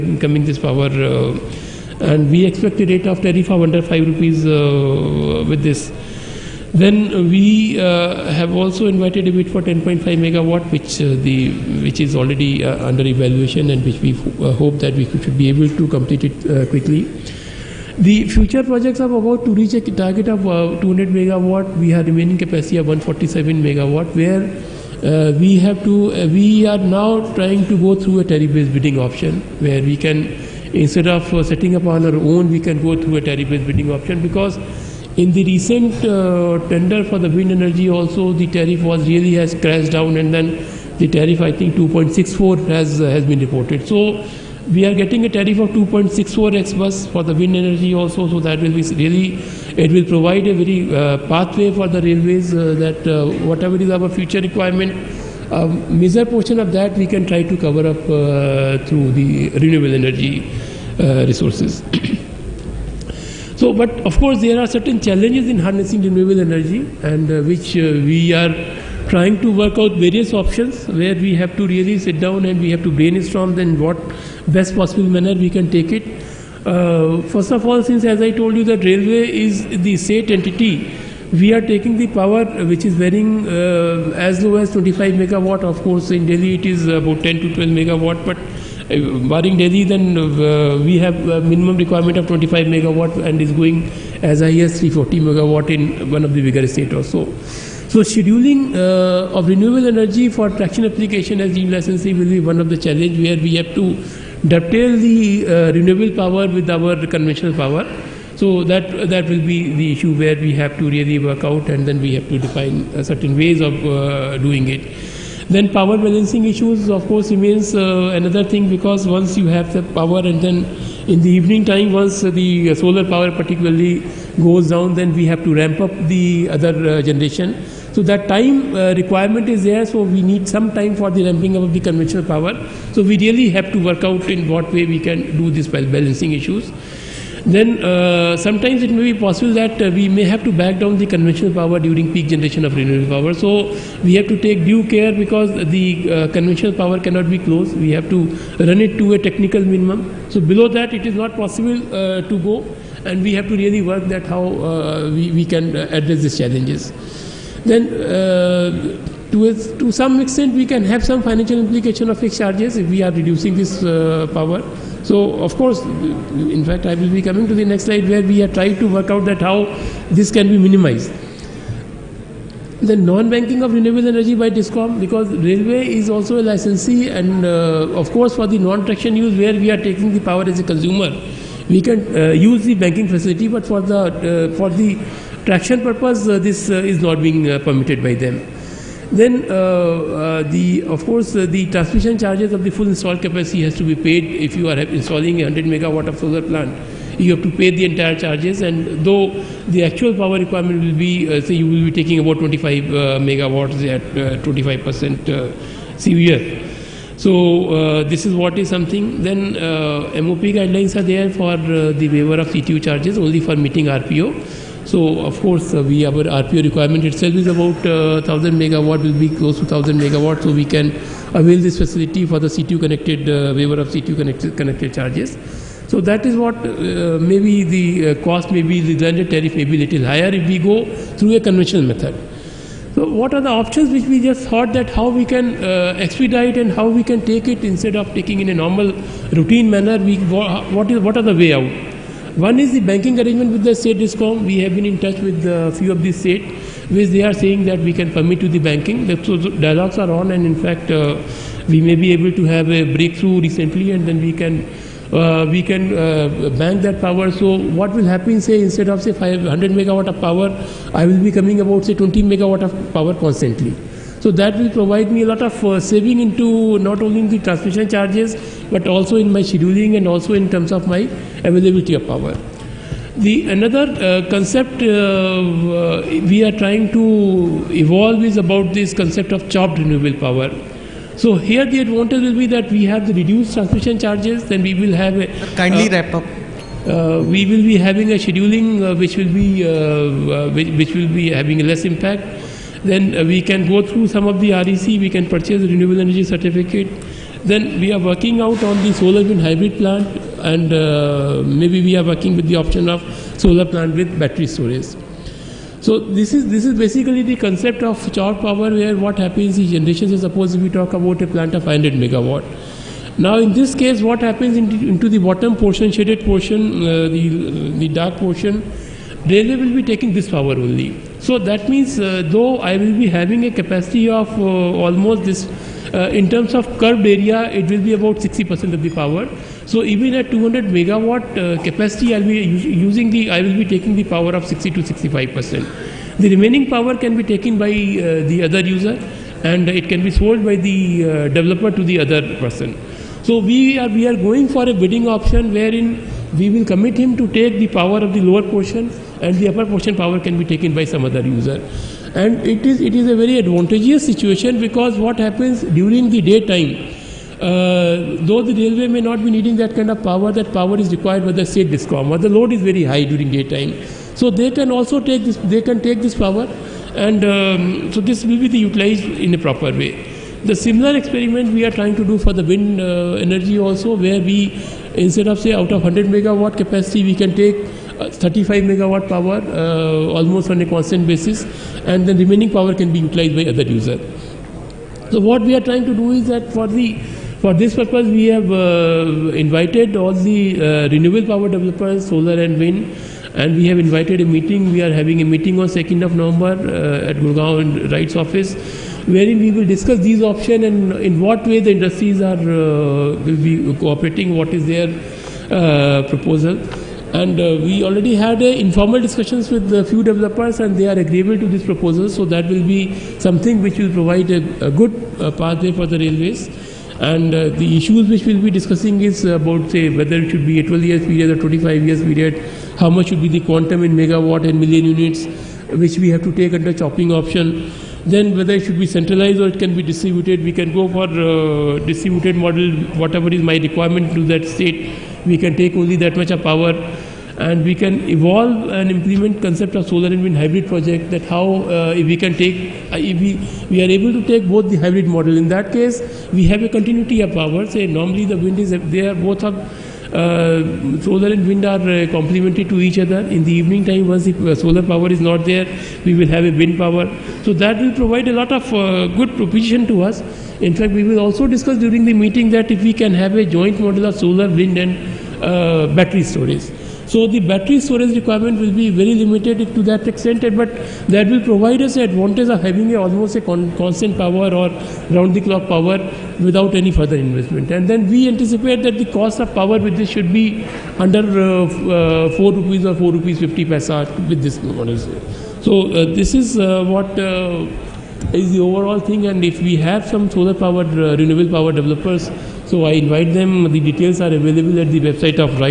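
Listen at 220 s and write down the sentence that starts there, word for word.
So, we can avail this facility for the CTU connected uh, waiver of CTU connected, connected charges.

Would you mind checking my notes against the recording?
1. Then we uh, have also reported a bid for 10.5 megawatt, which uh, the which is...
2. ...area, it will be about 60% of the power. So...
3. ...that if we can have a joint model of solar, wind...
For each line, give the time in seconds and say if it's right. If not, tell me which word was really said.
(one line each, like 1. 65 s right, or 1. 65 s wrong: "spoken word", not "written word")
1. 6 s wrong: "invited", not "reported"
2. 327 s right
3. 462 s right.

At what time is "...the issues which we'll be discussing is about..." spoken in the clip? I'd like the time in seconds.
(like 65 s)
417 s.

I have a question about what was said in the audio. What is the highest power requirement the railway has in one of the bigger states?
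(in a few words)
340 megawatt.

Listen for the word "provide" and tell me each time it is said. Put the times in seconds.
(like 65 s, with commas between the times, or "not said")
50 s, 264 s, 413 s, 457 s, 471 s.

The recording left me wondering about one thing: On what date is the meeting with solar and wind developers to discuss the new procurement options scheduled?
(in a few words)
2nd of November.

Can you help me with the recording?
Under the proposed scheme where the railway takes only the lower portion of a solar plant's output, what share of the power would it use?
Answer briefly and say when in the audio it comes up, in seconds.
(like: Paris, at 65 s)
60 to 65%, at 334 s.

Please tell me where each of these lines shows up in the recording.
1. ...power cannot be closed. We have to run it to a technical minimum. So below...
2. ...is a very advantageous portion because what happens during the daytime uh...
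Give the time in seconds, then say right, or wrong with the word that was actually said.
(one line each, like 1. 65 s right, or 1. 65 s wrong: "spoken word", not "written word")
1. 146 s right
2. 352 s wrong: "situation", not "portion".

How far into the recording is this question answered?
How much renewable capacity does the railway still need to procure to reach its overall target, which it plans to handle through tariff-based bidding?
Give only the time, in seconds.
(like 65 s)
22 s.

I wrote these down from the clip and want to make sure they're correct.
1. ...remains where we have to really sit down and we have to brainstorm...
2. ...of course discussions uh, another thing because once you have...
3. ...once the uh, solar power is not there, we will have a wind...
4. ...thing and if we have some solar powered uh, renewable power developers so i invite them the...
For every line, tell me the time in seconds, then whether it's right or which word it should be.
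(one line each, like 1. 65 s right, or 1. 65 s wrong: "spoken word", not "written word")
1. 70 s wrong: "options", not "remains"
2. 116 s wrong: "remains", not "discussions"
3. 454 s right
4. 488 s right.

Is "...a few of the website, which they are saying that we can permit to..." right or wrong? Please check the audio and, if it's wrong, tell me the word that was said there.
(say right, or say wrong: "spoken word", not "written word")
wrong: "state", not "website".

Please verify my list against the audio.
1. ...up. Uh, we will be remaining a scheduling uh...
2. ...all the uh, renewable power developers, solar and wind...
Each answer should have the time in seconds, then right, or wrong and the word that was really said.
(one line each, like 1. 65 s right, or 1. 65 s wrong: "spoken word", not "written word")
1. 286 s wrong: "having", not "remaining"
2. 389 s right.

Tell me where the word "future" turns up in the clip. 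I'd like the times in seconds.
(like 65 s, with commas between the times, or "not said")
18 s, 54 s.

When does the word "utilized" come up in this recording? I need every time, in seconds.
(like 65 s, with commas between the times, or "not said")
368 s, 382 s.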